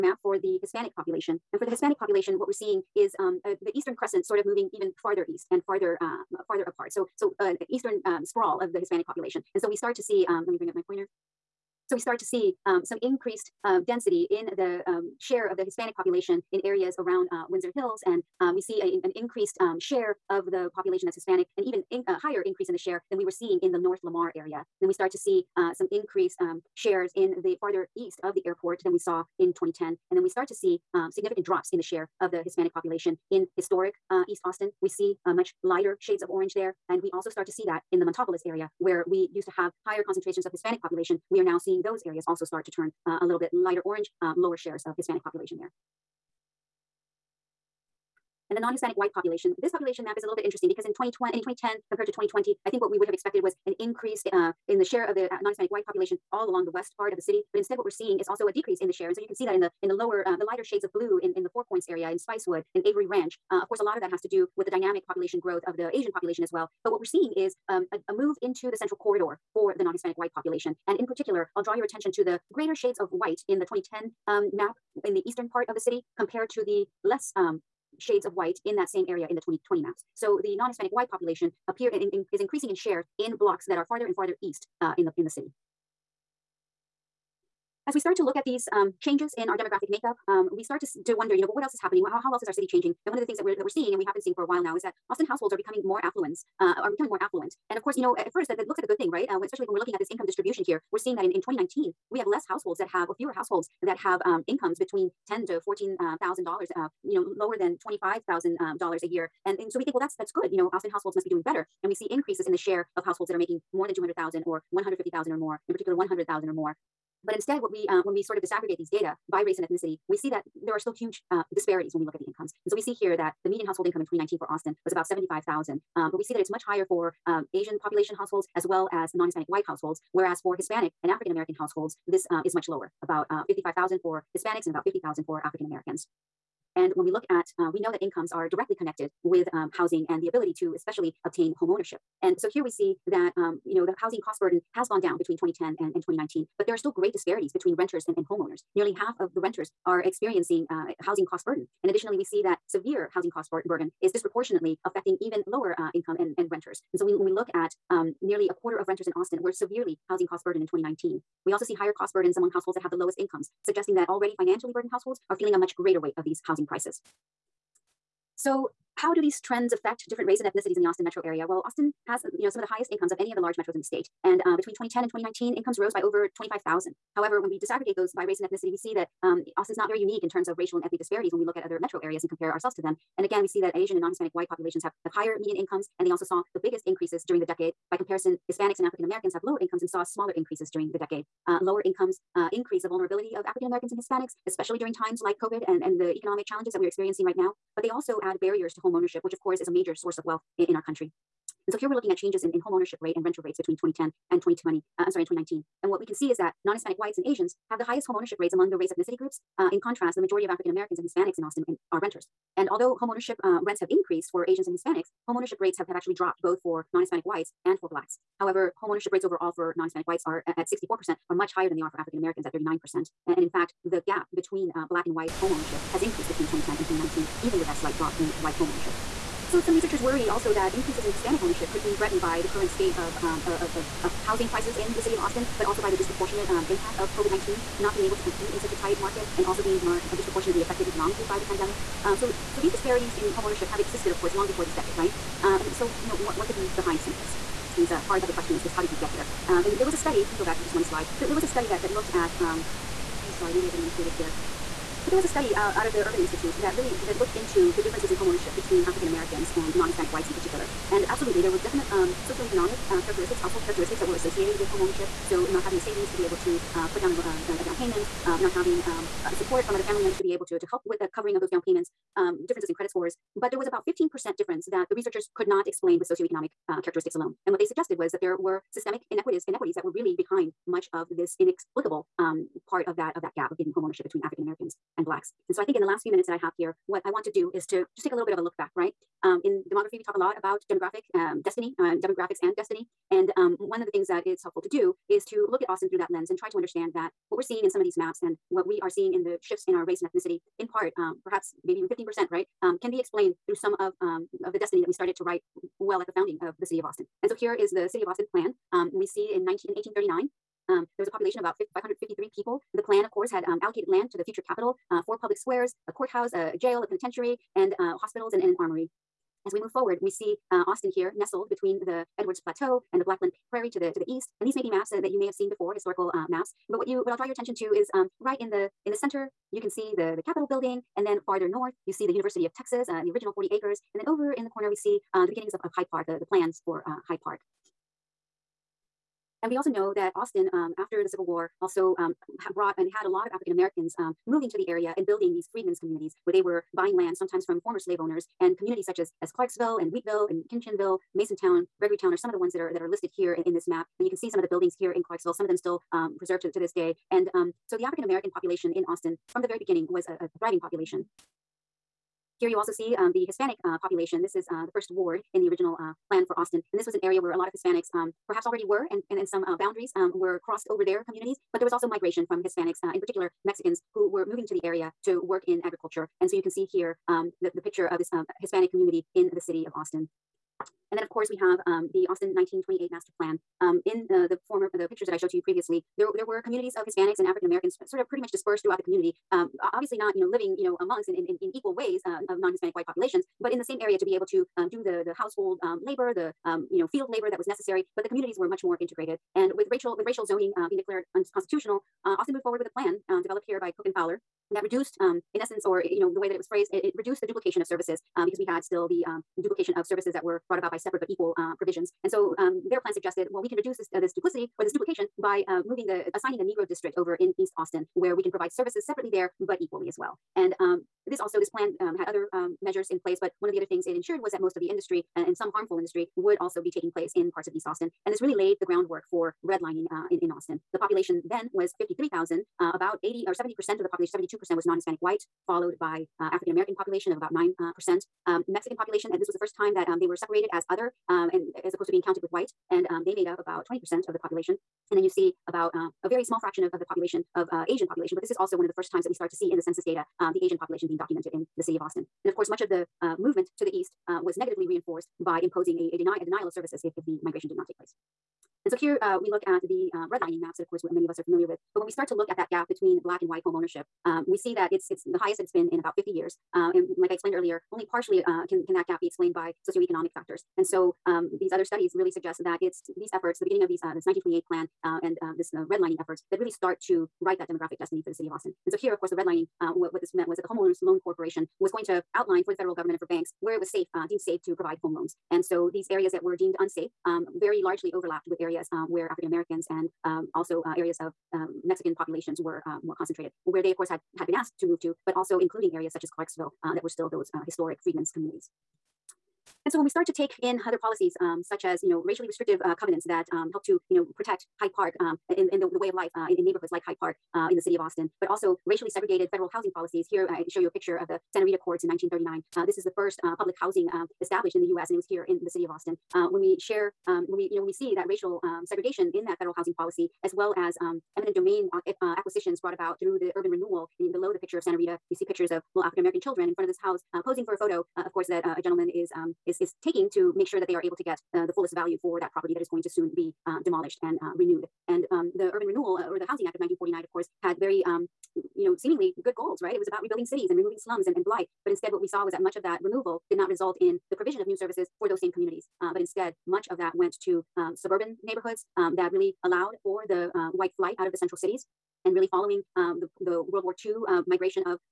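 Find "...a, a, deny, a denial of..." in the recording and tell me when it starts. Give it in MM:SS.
07:35.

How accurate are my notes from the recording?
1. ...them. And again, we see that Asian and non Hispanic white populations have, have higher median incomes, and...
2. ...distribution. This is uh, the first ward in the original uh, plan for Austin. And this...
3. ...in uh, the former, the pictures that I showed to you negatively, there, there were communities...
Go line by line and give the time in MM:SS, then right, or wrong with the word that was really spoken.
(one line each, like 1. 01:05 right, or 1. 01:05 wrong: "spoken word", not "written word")
1. 03:02 right
2. 06:03 wrong: "population", not "distribution"
3. 06:23 wrong: "previously", not "negatively".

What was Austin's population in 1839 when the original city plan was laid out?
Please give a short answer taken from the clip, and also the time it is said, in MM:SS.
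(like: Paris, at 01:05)
553, at 05:11.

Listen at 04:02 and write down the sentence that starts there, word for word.
Um, so so these disparities in home ownership have existed, of course, long before this decade, right?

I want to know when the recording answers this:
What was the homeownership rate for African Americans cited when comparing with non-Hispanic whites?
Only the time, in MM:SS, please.
03:42.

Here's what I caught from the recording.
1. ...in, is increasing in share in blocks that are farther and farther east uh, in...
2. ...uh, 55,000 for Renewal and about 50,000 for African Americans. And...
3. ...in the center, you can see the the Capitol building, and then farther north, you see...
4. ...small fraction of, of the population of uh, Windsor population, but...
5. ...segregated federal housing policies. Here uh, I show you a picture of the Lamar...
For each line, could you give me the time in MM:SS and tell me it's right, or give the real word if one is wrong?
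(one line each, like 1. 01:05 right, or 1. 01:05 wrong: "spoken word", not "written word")
1. 01:22 right
2. 02:13 wrong: "Hispanics", not "Renewal"
3. 05:28 right
4. 07:26 wrong: "Asian", not "Windsor"
5. 08:28 wrong: "Santa", not "Lamar".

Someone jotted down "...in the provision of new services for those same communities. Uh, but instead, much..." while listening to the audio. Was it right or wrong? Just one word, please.
right.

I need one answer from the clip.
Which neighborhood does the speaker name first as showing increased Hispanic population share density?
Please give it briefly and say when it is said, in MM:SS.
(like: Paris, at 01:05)
Windsor Hills, at 00:17.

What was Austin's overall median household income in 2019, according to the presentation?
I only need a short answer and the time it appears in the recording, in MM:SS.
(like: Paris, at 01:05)
about 75,000, at 02:04.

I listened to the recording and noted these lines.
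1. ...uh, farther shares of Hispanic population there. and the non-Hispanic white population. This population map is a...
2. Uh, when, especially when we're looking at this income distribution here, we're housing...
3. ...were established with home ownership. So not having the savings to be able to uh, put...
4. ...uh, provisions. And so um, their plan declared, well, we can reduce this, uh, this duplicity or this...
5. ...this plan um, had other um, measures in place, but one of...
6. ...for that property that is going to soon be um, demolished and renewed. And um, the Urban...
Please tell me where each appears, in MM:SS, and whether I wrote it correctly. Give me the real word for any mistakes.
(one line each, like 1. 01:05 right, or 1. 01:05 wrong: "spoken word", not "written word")
1. 00:44 wrong: "lower", not "farther"
2. 01:39 wrong: "seeing", not "housing"
3. 04:24 wrong: "associated", not "established"
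4. 06:51 wrong: "suggested", not "declared"
5. 07:01 right
6. 08:52 right.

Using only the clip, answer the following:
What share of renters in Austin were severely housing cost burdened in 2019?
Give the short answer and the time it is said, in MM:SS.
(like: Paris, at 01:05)
nearly a quarter, at 02:38.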